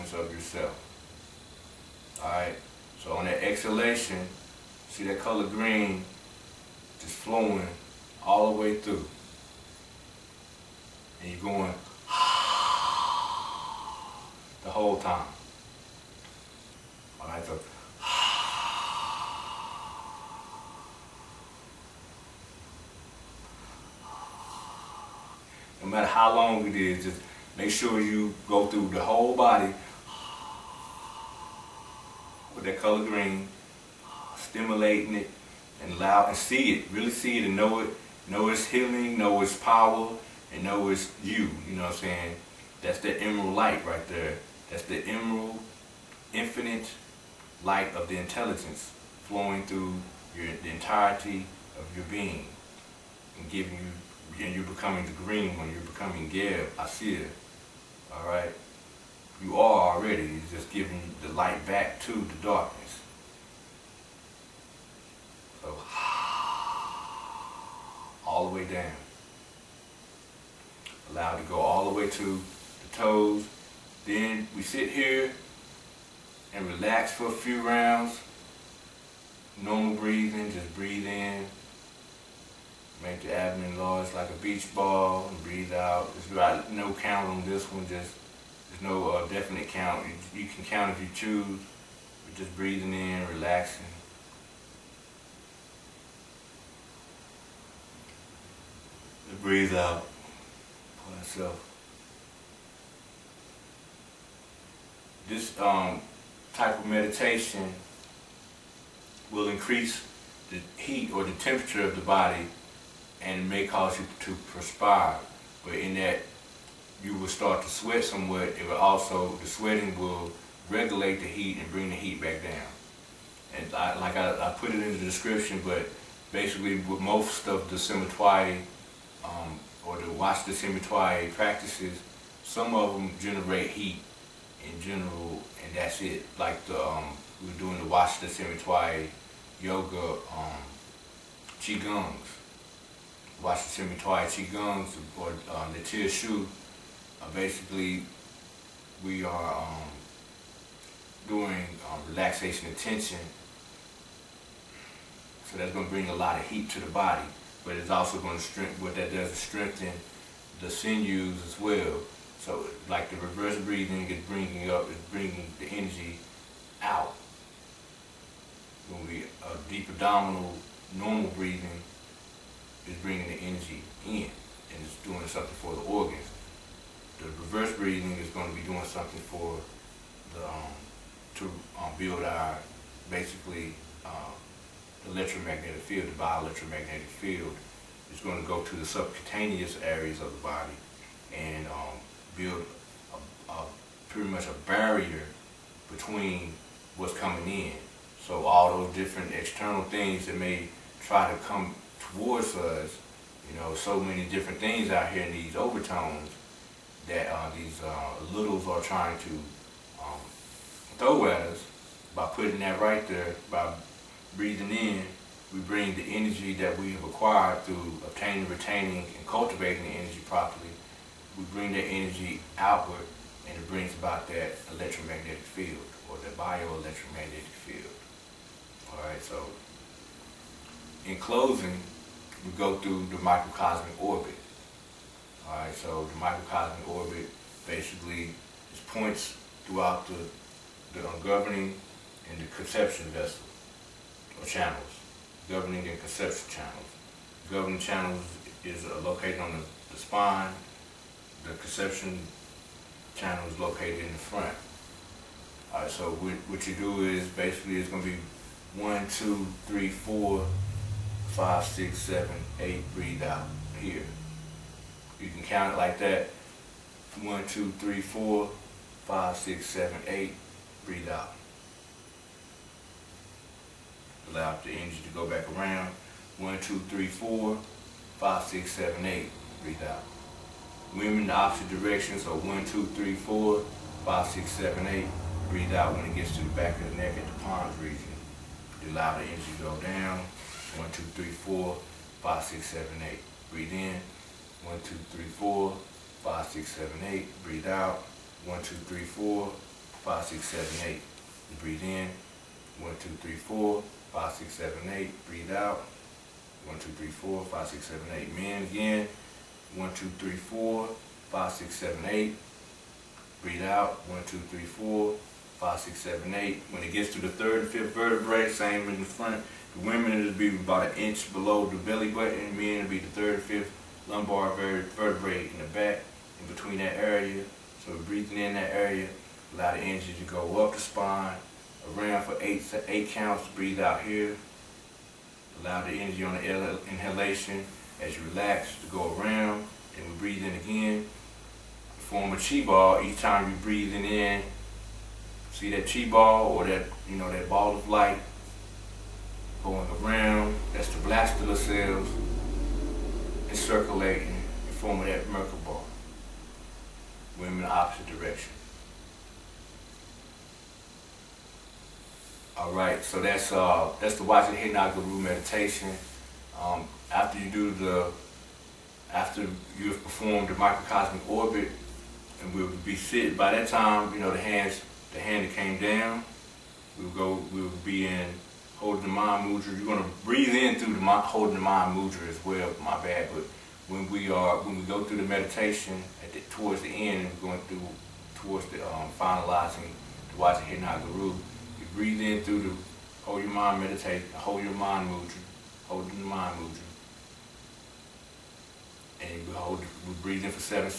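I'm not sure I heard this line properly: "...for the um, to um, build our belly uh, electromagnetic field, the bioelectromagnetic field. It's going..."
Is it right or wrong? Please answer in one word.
wrong.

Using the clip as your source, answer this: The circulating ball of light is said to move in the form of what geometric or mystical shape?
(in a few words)
merkaba.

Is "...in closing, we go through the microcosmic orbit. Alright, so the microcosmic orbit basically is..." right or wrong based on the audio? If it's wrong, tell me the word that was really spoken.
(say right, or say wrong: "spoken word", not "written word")
right.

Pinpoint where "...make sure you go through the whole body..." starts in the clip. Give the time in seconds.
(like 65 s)
27 s.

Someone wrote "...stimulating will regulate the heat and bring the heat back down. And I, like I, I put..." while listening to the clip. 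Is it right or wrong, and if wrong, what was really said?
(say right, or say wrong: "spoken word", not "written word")
wrong: "sweating", not "stimulating".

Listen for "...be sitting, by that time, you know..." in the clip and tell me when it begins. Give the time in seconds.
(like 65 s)
372 s.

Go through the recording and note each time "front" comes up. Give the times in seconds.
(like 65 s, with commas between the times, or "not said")
254 s, 319 s.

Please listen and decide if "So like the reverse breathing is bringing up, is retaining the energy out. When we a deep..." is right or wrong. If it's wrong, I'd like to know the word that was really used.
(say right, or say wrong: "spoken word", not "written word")
wrong: "bringing", not "retaining".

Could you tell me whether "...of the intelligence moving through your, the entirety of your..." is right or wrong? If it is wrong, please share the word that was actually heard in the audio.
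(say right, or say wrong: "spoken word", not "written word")
wrong: "flowing", not "moving".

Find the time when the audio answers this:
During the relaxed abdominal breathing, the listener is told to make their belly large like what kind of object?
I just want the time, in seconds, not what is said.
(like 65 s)
84 s.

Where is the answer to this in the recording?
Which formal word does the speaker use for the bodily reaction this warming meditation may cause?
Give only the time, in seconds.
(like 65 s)
114 s.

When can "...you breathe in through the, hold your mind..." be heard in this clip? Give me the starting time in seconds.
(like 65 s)
391 s.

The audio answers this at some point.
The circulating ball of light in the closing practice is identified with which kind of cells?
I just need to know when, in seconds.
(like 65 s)
350 s.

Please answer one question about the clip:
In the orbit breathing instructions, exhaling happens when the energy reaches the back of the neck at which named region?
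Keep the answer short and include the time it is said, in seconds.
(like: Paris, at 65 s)
pons region, at 287 s.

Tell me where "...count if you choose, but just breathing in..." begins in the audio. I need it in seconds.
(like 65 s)
90 s.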